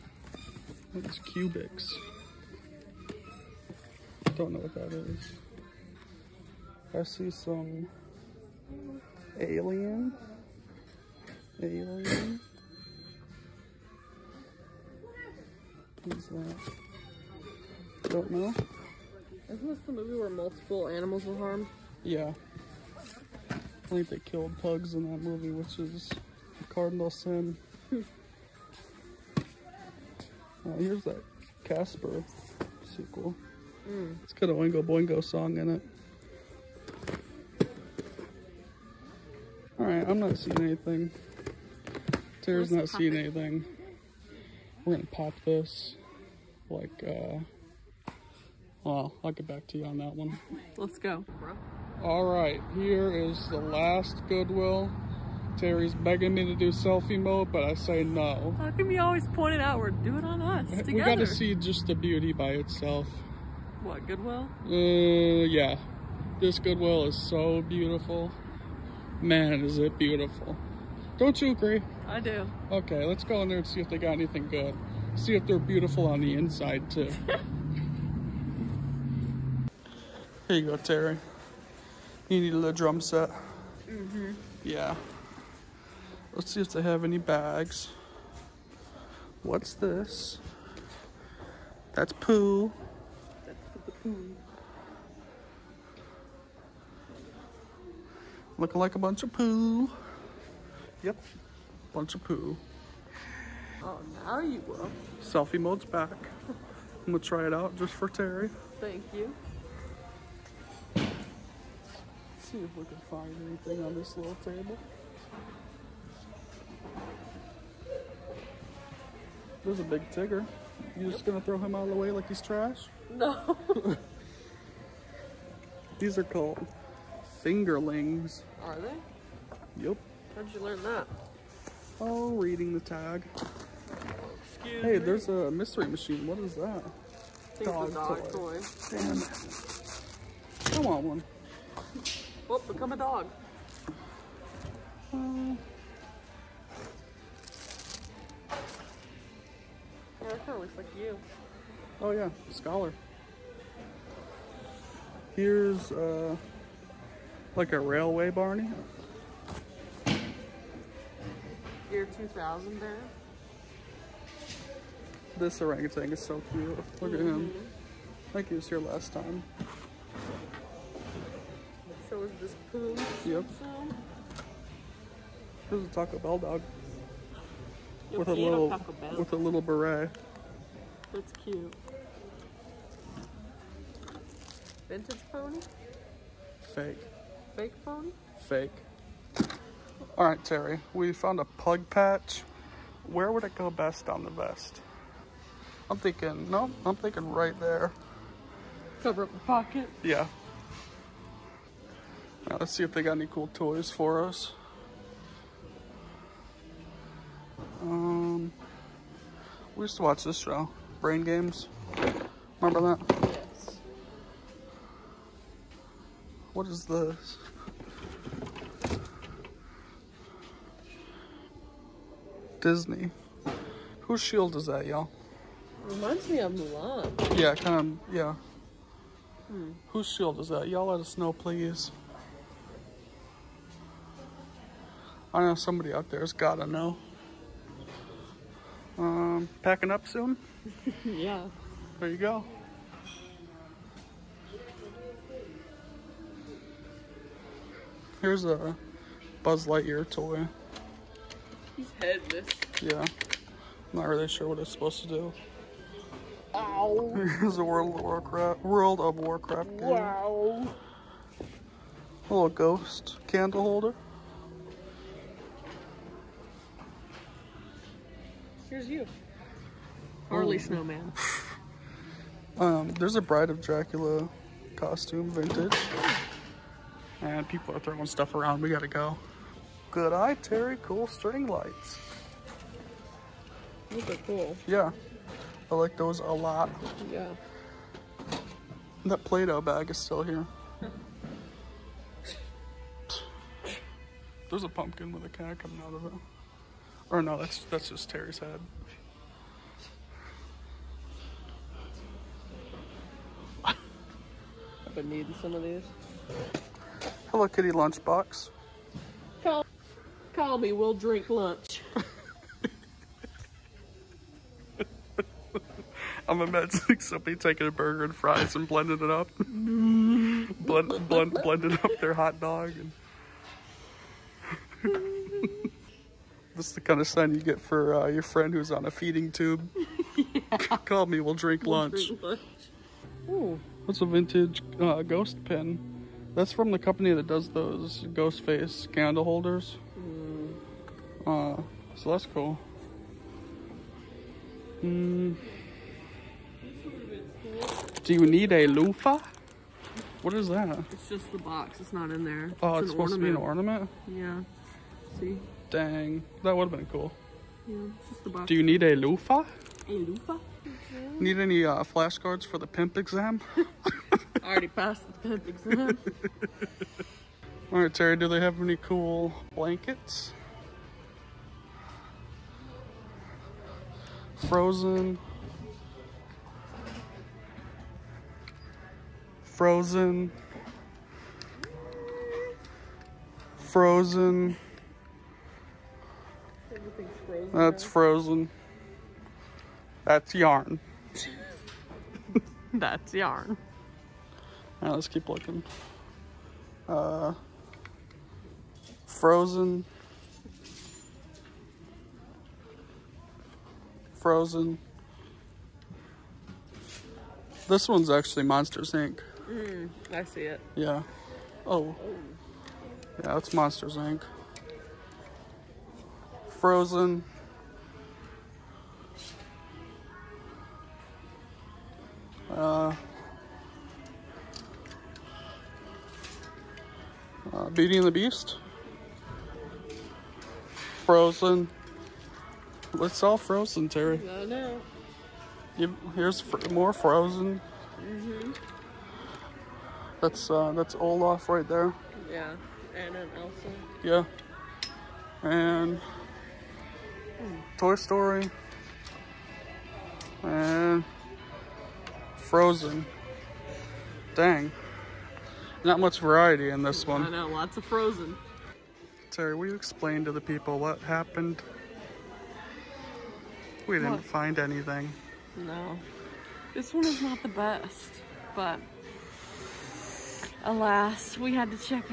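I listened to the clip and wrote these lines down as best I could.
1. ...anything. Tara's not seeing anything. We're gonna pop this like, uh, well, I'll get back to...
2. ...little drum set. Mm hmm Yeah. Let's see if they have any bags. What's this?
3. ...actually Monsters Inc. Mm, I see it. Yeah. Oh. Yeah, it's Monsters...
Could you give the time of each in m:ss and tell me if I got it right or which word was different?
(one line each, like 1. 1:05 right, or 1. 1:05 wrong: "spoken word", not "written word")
1. 0:40 right
2. 1:22 right
3. 6:48 right.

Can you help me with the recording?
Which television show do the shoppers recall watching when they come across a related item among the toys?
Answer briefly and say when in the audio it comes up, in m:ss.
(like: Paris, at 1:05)
Brain Games, at 3:31.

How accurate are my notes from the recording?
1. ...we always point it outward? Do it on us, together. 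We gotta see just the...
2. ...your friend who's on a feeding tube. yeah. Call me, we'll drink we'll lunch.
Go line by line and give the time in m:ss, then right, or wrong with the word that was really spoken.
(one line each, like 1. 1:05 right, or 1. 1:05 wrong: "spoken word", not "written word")
1. 0:58 right
2. 5:28 right.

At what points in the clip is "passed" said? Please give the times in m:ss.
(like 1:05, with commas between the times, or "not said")
6:04.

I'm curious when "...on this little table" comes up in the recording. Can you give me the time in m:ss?
1:53.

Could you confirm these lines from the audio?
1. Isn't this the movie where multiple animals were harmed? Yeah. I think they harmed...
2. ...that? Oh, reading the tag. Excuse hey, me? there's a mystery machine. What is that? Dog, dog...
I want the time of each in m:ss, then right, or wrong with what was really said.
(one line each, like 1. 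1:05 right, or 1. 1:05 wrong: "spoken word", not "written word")
1. 0:19 wrong: "killed", not "harmed"
2. 2:10 right.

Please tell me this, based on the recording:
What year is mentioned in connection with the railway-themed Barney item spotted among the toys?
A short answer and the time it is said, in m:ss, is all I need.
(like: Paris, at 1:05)
2000, at 2:41.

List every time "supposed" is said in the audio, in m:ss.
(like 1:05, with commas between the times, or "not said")
4:14, 5:52.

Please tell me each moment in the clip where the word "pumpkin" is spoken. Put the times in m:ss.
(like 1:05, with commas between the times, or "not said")
4:54.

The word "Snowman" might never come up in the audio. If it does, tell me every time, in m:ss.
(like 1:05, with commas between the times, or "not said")
4:30.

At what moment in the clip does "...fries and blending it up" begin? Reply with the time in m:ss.
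5:18.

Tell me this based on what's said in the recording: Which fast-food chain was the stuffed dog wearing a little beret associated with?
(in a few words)
Taco Bell.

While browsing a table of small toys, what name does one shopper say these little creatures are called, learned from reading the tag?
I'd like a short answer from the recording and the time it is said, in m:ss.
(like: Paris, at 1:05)
Fingerlings, at 2:07.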